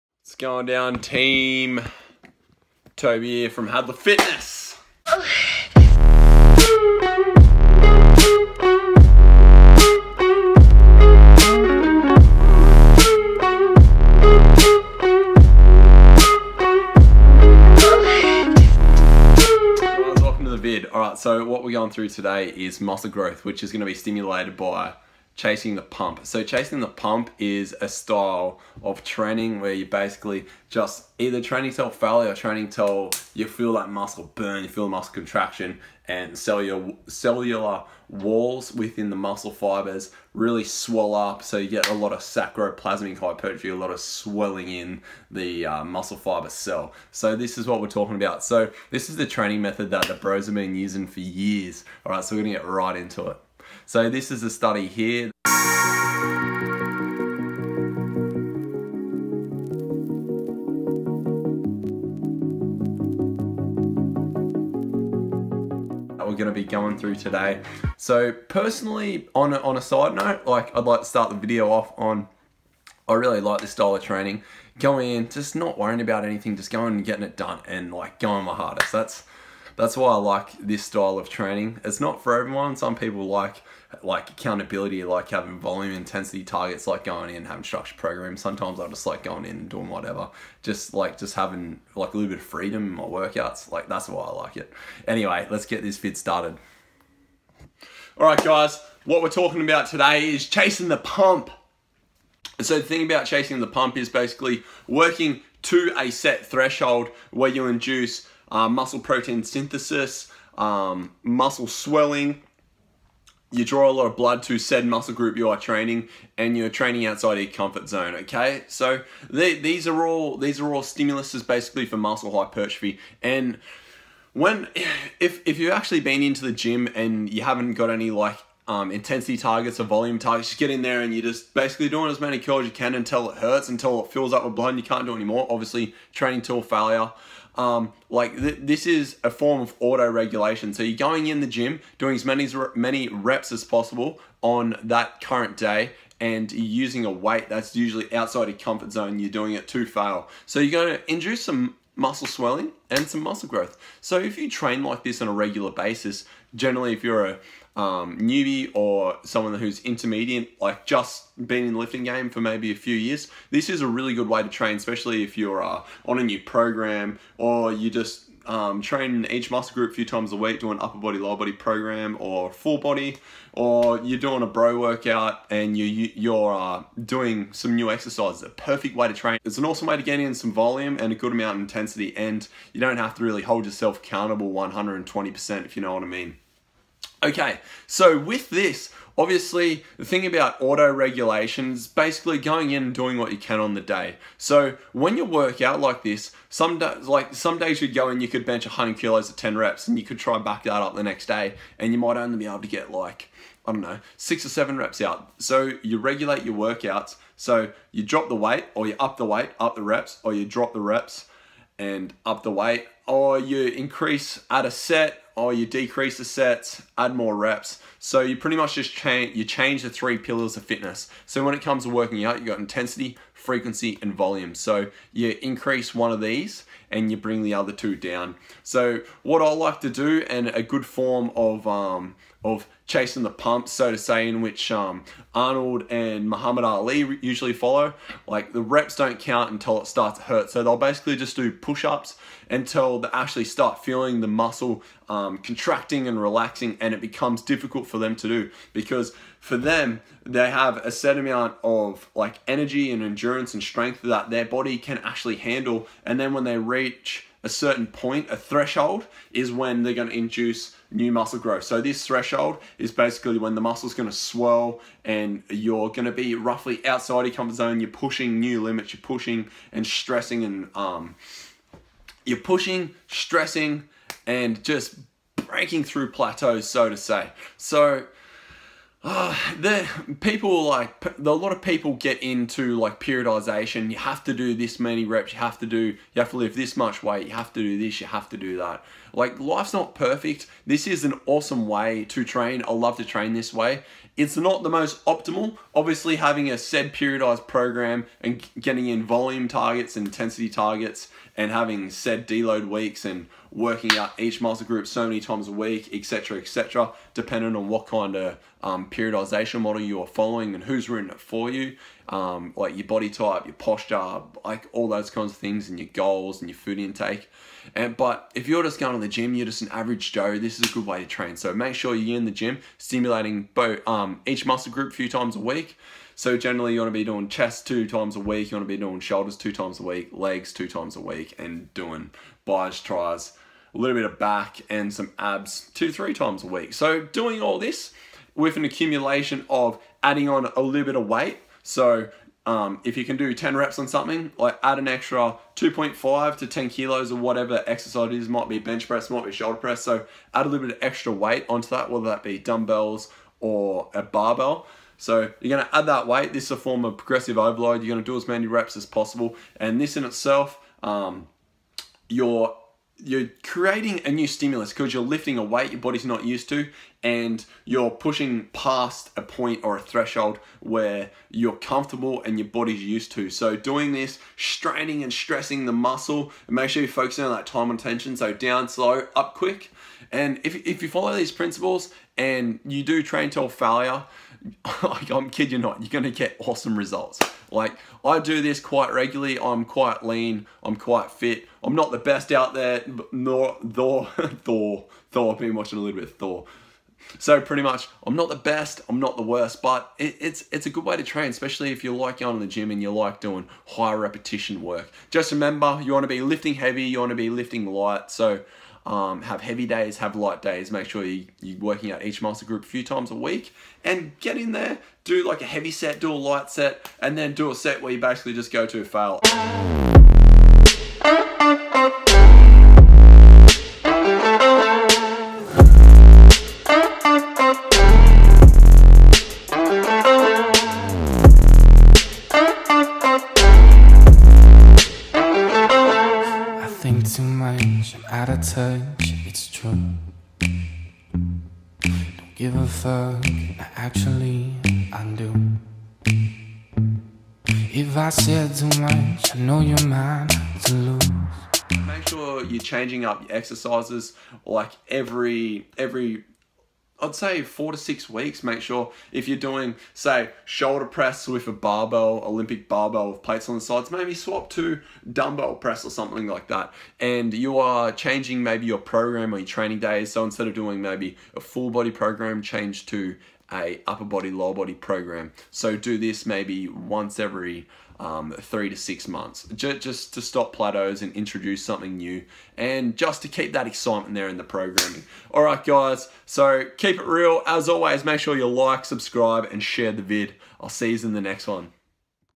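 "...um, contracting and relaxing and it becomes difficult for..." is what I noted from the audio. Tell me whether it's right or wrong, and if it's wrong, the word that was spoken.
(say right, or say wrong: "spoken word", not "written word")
right.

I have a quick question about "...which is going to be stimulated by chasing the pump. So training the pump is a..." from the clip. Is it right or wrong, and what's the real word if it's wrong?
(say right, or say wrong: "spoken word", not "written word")
wrong: "chasing", not "training".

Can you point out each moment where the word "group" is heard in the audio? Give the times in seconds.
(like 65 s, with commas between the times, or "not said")
115 s, 169 s, 304 s, 324 s, 412 s.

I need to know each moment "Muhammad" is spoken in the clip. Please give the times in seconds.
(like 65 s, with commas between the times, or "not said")
236 s.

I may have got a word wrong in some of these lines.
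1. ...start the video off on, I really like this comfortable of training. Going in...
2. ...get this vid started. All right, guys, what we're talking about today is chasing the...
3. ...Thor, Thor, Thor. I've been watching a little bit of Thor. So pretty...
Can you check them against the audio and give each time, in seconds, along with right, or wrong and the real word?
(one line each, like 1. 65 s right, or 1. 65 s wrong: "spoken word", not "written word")
1. 71 s wrong: "style", not "comfortable"
2. 95 s right
3. 393 s right.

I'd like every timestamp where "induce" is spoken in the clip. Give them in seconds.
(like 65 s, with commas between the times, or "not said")
107 s, 151 s, 260 s.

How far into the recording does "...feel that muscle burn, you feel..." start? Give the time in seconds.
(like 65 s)
33 s.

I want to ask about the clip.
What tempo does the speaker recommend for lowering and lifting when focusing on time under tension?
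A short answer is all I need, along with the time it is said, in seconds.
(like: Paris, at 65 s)
down slow, up quick, at 378 s.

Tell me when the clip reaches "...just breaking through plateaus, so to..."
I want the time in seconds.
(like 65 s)
274 s.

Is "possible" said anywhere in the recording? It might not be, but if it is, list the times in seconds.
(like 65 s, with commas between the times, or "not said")
143 s, 358 s.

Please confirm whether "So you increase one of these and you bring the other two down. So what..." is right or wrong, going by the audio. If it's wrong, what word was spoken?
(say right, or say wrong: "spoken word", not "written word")
right.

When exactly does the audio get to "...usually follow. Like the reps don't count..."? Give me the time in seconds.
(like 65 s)
237 s.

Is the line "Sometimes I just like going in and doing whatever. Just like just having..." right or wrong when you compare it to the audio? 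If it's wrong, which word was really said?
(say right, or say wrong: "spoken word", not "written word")
right.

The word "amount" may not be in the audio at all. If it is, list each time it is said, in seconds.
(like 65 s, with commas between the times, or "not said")
181 s, 251 s.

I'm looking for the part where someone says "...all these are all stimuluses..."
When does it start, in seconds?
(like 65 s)
120 s.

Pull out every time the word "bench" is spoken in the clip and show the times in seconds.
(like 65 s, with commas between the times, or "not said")
198 s, 348 s.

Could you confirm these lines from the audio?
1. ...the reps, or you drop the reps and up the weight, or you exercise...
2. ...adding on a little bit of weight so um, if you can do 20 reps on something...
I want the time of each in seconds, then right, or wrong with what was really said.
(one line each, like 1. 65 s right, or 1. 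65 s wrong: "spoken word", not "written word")
1. 209 s wrong: "increase", not "exercise"
2. 340 s wrong: "10", not "20".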